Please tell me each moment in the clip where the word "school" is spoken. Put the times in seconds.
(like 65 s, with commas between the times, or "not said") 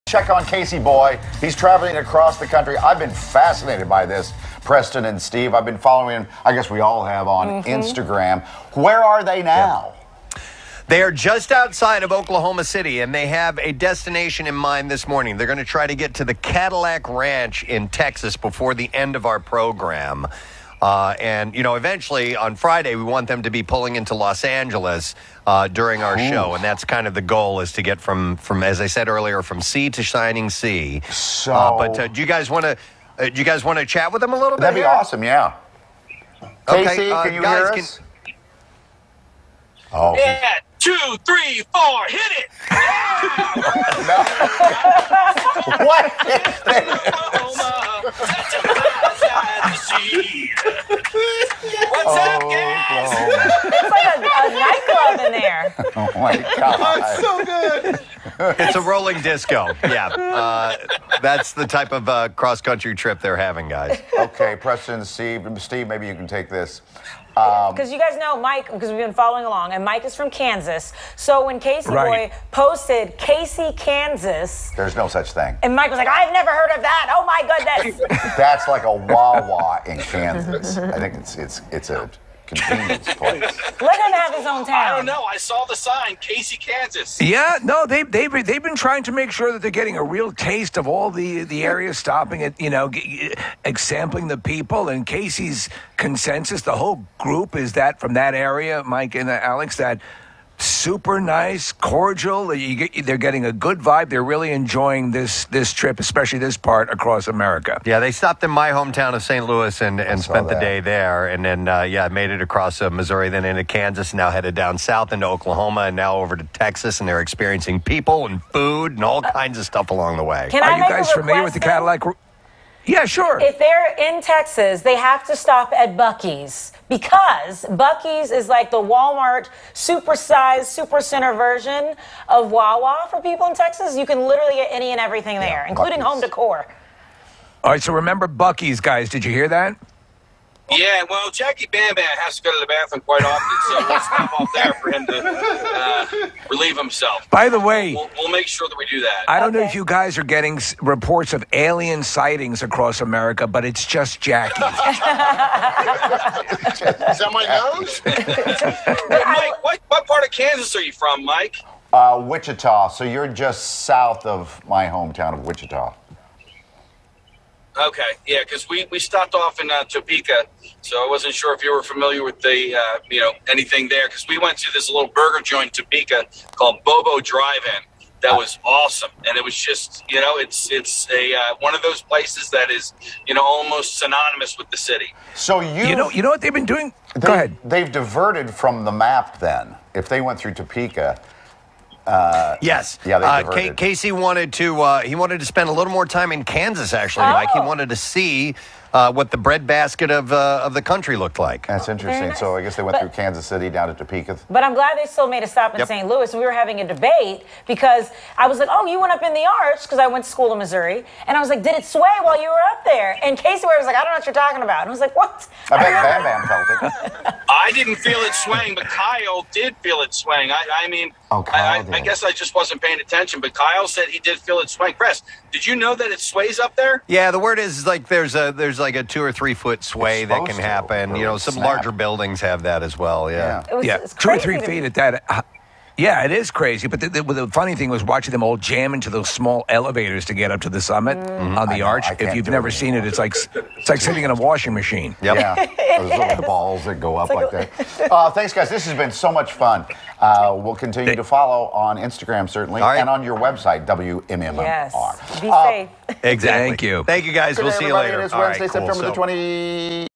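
210 s.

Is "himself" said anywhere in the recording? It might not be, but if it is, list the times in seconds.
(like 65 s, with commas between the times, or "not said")
146 s.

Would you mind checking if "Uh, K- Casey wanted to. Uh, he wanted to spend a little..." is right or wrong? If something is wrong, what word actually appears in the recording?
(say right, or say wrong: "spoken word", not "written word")
right.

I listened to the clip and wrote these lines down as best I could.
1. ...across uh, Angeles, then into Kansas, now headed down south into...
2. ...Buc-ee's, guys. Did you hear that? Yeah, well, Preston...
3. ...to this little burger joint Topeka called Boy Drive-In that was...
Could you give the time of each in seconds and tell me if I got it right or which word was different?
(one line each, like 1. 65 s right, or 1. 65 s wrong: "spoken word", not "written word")
1. 112 s wrong: "Missouri", not "Angeles"
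2. 138 s wrong: "Jackie", not "Preston"
3. 174 s wrong: "Bobo", not "Boy".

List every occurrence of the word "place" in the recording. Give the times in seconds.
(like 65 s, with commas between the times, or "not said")
83 s, 182 s.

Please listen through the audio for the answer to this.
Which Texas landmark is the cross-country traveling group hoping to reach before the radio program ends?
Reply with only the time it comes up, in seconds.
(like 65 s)
16 s.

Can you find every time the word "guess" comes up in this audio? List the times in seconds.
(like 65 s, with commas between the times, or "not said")
6 s, 202 s, 222 s.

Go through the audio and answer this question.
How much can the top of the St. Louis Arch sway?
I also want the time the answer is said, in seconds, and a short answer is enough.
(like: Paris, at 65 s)
2 or 3 feet, at 229 s.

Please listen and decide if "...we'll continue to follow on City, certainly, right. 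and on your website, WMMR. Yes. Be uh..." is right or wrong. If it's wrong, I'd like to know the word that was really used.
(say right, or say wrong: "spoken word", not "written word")
wrong: "Instagram", not "City".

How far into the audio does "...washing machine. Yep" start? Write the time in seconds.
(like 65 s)
244 s.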